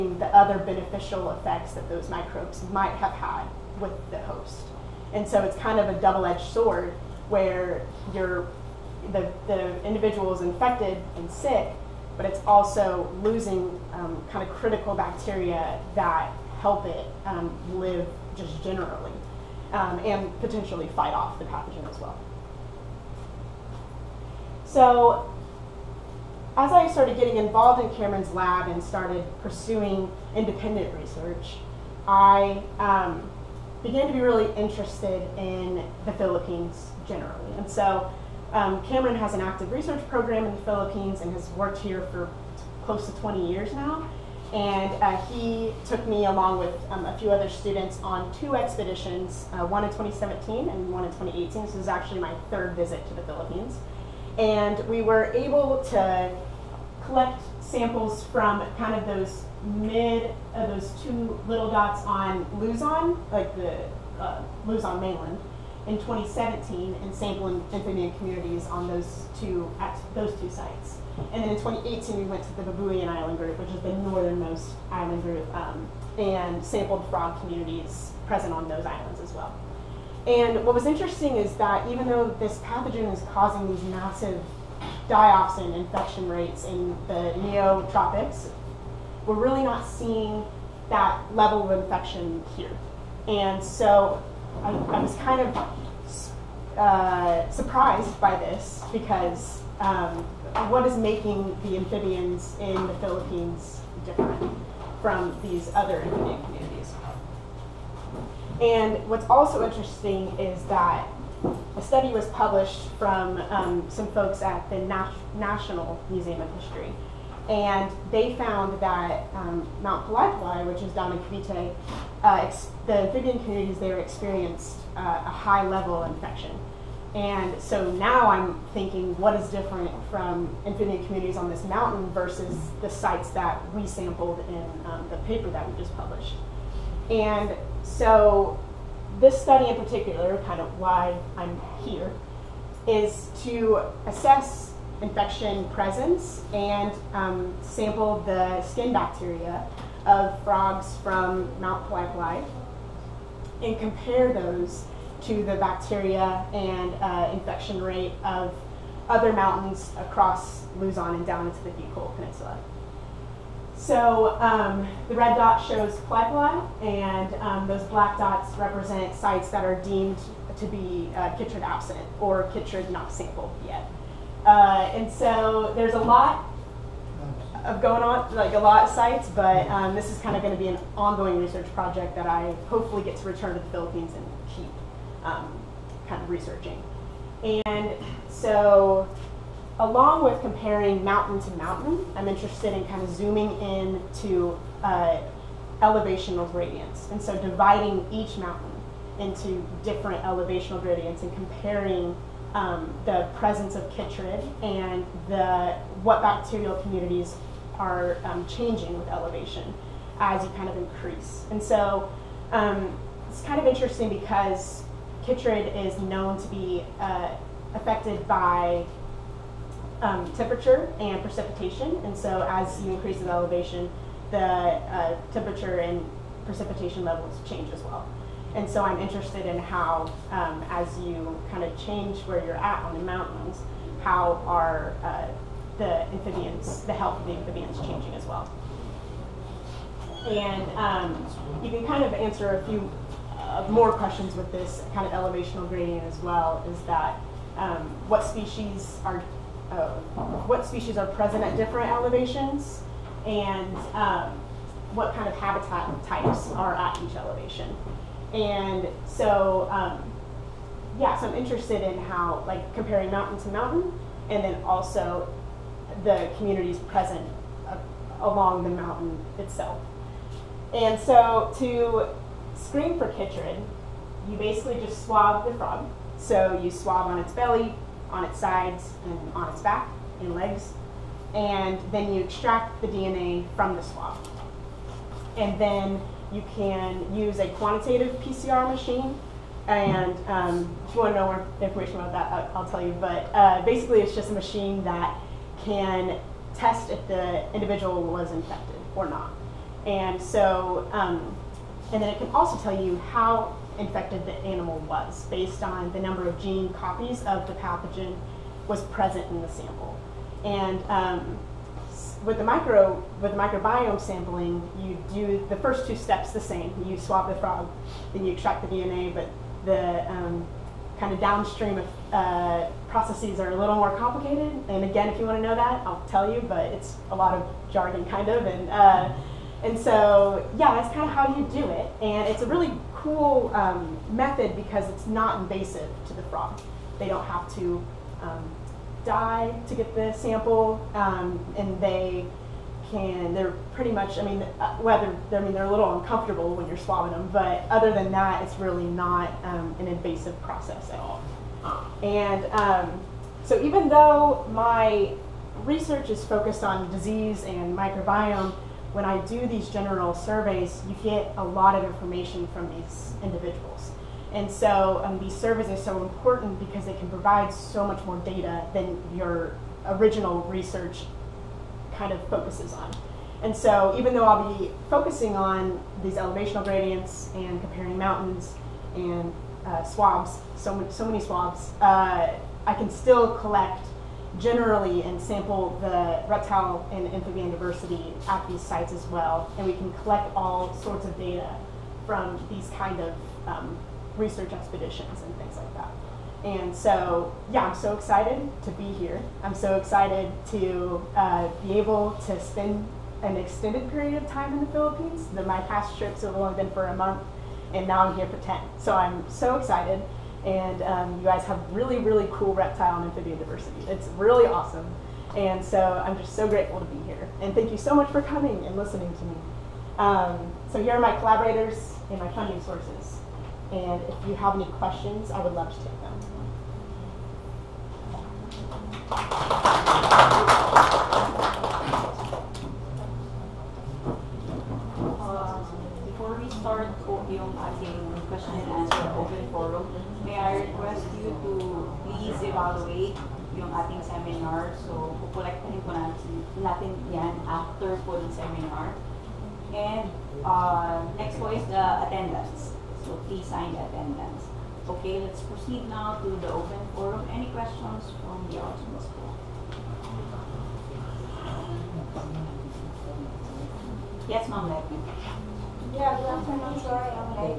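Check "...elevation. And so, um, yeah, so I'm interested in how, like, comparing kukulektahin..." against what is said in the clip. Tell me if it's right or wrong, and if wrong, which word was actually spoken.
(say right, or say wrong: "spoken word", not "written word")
wrong: "mountain", not "kukulektahin".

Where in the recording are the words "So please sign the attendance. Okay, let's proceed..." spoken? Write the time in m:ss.
7:33.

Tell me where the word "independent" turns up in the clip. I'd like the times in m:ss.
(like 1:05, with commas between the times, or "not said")
0:30.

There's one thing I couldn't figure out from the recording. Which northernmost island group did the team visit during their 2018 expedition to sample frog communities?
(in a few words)
Babuyan Island group.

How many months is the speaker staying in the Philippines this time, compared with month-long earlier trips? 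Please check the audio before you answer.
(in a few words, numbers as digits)
10.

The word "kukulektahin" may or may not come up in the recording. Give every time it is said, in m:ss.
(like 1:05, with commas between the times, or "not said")
7:25.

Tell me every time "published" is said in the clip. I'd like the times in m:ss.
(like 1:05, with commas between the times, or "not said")
1:52, 2:15.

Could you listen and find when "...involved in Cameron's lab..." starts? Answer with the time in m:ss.
0:27.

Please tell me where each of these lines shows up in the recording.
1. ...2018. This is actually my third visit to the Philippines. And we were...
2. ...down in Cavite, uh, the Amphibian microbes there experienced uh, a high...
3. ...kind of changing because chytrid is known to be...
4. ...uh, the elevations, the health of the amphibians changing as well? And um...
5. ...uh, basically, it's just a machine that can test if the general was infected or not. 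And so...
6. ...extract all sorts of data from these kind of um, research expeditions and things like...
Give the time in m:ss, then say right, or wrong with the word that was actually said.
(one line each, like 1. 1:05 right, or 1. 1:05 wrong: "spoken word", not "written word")
1. 0:51 right
2. 2:00 wrong: "communities", not "microbes"
3. 3:33 wrong: "interesting", not "changing"
4. 3:55 wrong: "amphibians", not "elevations"
5. 4:53 wrong: "individual", not "general"
6. 6:29 wrong: "collect", not "extract".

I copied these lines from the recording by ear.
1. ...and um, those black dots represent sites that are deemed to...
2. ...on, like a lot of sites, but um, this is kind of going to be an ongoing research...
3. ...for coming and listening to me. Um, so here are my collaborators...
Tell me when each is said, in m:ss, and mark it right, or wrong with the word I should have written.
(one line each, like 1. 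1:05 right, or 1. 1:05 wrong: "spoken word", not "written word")
1. 2:46 right
2. 2:58 right
3. 6:58 right.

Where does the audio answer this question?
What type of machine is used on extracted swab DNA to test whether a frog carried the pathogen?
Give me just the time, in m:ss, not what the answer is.
4:47.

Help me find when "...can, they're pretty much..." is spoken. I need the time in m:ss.
5:42.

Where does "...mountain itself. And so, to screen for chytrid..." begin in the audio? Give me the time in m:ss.
4:28.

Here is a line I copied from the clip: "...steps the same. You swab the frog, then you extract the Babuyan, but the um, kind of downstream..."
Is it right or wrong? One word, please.
wrong.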